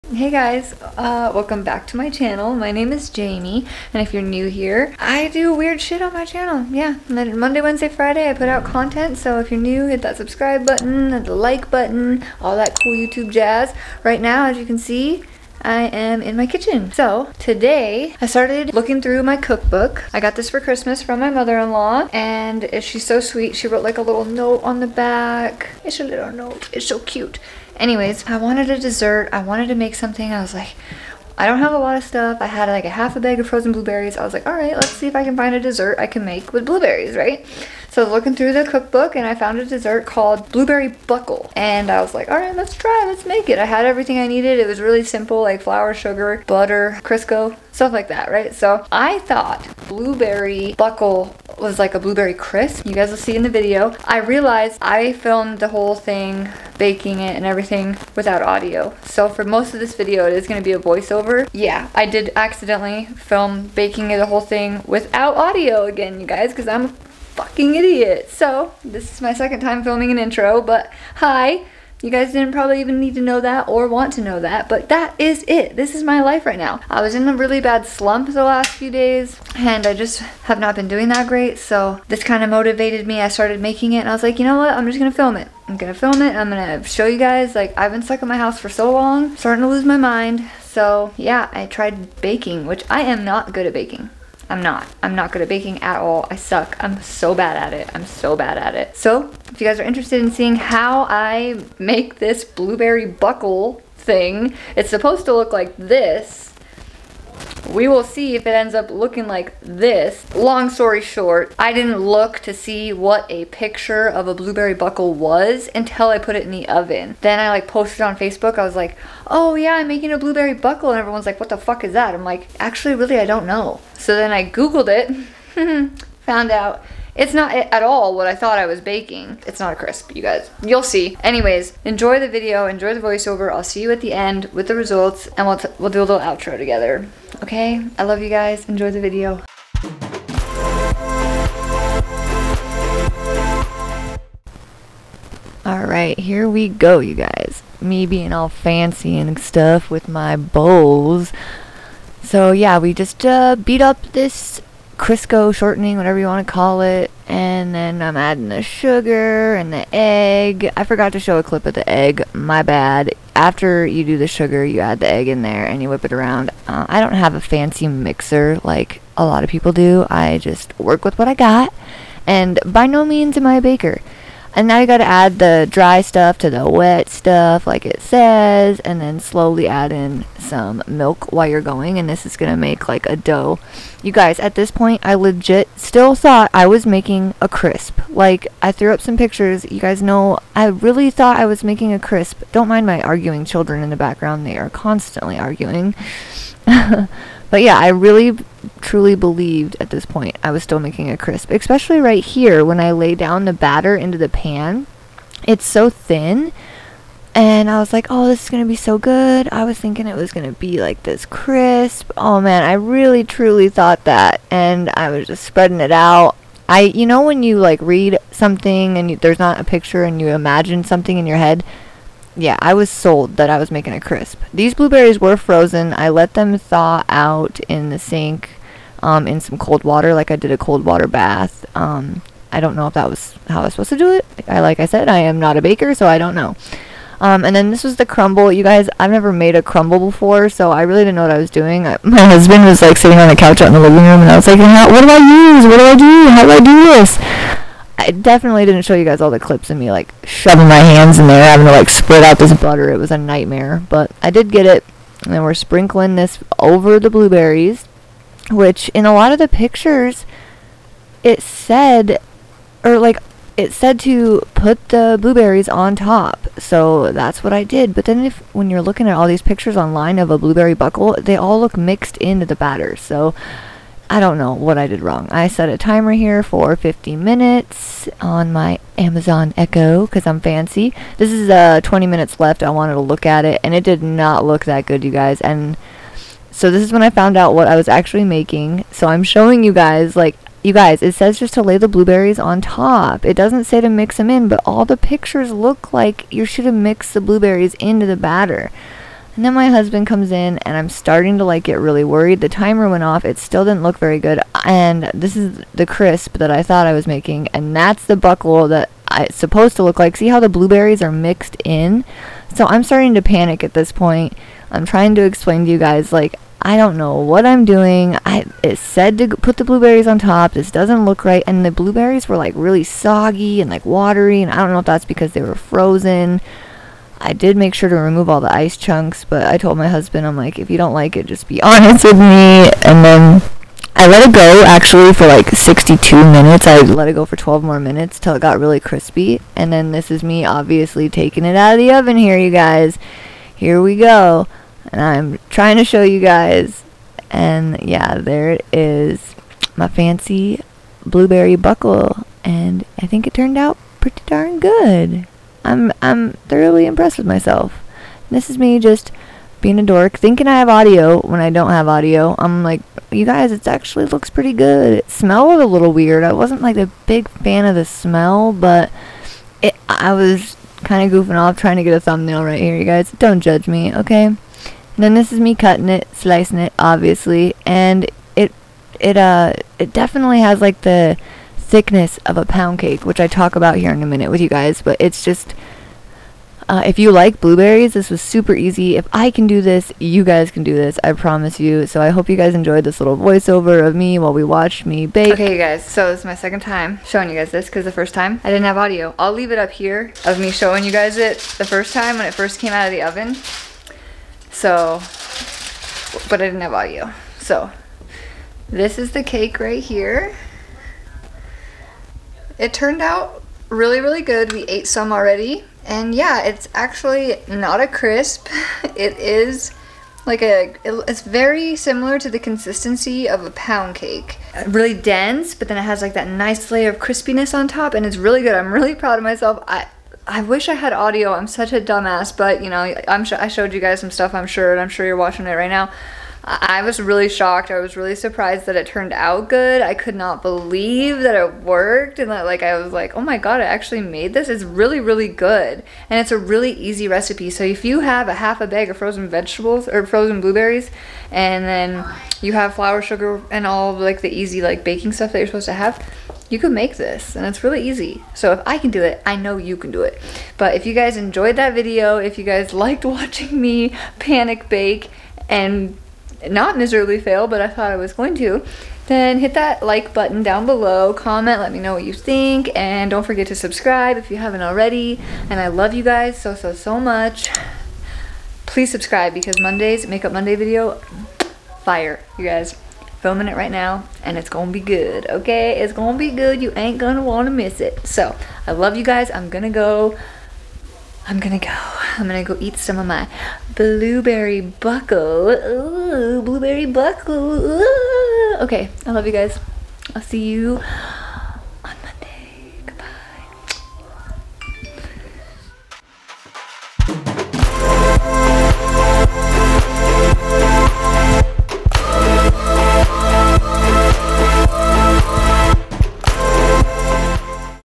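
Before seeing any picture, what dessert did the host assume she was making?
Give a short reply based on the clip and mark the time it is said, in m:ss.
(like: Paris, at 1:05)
A blueberry crisp, at 0:51.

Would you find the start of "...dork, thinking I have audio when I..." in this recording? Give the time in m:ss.
5:59.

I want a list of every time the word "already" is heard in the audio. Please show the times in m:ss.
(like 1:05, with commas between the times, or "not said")
6:55, 7:54.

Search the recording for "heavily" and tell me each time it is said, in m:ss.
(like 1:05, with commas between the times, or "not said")
not said.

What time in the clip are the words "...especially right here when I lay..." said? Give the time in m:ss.
3:21.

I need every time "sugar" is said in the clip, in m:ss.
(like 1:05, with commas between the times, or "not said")
0:45, 2:38, 2:44, 7:33.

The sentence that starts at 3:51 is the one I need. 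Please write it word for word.
Um, I don't know if that was how I was supposed to do it.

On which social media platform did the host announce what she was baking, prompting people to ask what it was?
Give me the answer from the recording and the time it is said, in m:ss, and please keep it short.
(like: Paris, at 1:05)
Facebook, at 1:58.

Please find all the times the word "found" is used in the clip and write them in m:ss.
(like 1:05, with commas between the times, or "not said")
0:39, 2:06, 4:47.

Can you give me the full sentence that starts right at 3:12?
Don't mind my arguing children in the background.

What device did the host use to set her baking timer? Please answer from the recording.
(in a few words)
Amazon Echo.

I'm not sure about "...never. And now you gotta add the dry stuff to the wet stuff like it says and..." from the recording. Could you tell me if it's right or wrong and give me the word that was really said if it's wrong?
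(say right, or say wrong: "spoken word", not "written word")
wrong: "baker", not "never".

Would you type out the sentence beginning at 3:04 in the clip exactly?
You guys, at this point I legit still thought I was making a crisp.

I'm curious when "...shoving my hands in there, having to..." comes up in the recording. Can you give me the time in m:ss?
4:10.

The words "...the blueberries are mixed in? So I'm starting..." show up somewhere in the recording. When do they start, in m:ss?
5:10.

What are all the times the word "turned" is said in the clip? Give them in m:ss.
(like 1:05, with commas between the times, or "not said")
5:53, 6:52, 7:18.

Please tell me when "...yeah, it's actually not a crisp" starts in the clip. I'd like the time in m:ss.
6:56.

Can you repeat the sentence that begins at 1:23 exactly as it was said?
I started making it, and I was like, you know what?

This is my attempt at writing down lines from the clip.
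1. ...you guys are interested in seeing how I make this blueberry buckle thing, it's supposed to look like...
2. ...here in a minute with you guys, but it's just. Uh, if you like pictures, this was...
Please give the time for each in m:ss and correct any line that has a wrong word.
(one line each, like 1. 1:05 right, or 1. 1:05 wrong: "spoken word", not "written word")
1. 1:39 right
2. 6:23 wrong: "blueberries", not "pictures".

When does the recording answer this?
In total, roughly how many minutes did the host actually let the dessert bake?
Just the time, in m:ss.
5:35.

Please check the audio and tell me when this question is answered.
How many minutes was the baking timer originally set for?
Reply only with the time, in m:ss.
4:36.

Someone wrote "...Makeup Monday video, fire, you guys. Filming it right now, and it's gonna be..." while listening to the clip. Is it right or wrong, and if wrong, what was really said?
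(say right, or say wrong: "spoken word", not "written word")
right.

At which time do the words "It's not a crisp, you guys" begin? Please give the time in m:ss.
2:09.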